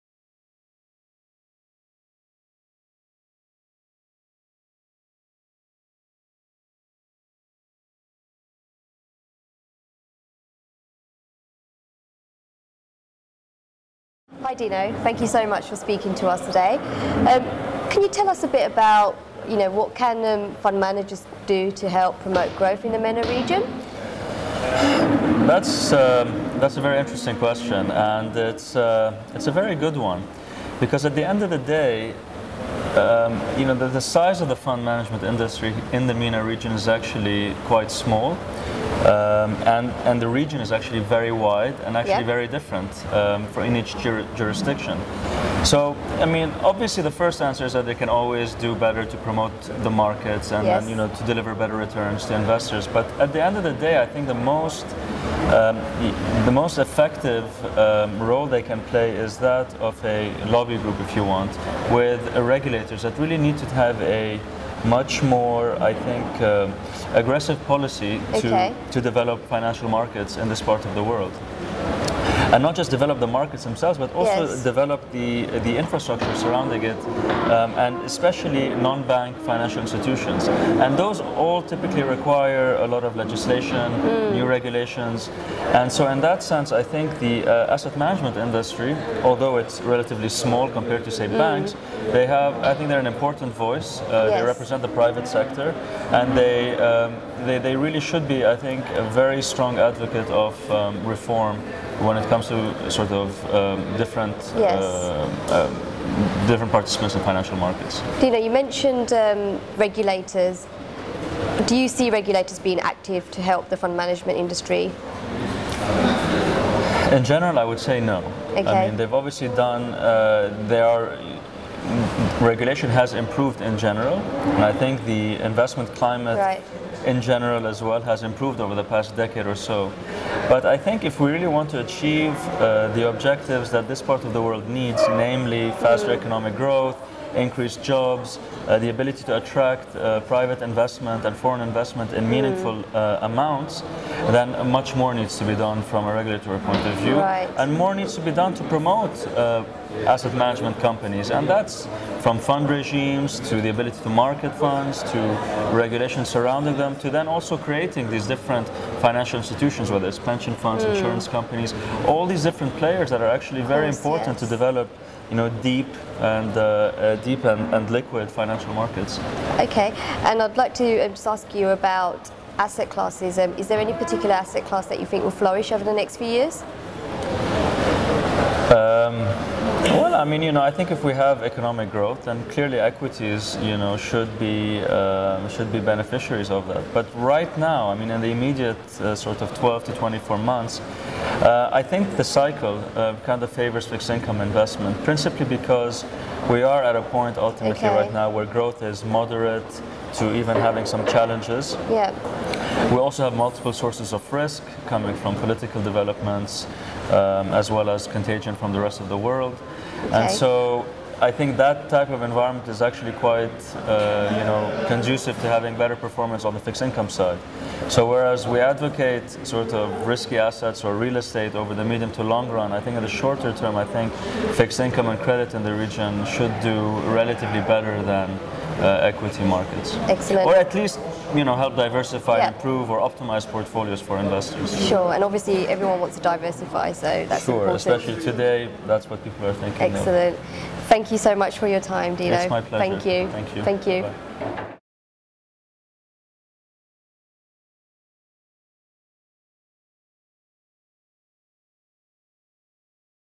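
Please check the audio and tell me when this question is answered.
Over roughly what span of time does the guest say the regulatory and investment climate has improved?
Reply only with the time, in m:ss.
2:08.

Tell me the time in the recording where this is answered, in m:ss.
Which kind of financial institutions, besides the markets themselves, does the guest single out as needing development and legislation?
1:18.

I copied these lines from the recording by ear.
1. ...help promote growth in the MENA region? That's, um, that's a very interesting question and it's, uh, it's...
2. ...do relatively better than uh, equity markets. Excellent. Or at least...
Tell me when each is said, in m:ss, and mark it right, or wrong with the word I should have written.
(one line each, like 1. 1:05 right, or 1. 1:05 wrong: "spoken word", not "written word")
1. 0:21 right
2. 3:46 right.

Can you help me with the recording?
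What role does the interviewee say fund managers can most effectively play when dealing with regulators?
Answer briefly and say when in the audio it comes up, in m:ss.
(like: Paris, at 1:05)
a lobby group, at 1:00.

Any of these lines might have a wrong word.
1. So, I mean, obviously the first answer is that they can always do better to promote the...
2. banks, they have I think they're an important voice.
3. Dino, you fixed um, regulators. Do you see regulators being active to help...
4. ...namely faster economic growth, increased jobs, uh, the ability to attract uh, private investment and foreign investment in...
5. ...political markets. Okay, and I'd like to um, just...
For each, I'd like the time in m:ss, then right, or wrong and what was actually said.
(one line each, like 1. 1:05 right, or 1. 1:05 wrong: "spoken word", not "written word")
1. 0:45 right
2. 1:31 right
3. 1:48 wrong: "mentioned", not "fixed"
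4. 2:15 right
5. 2:48 wrong: "financial", not "political".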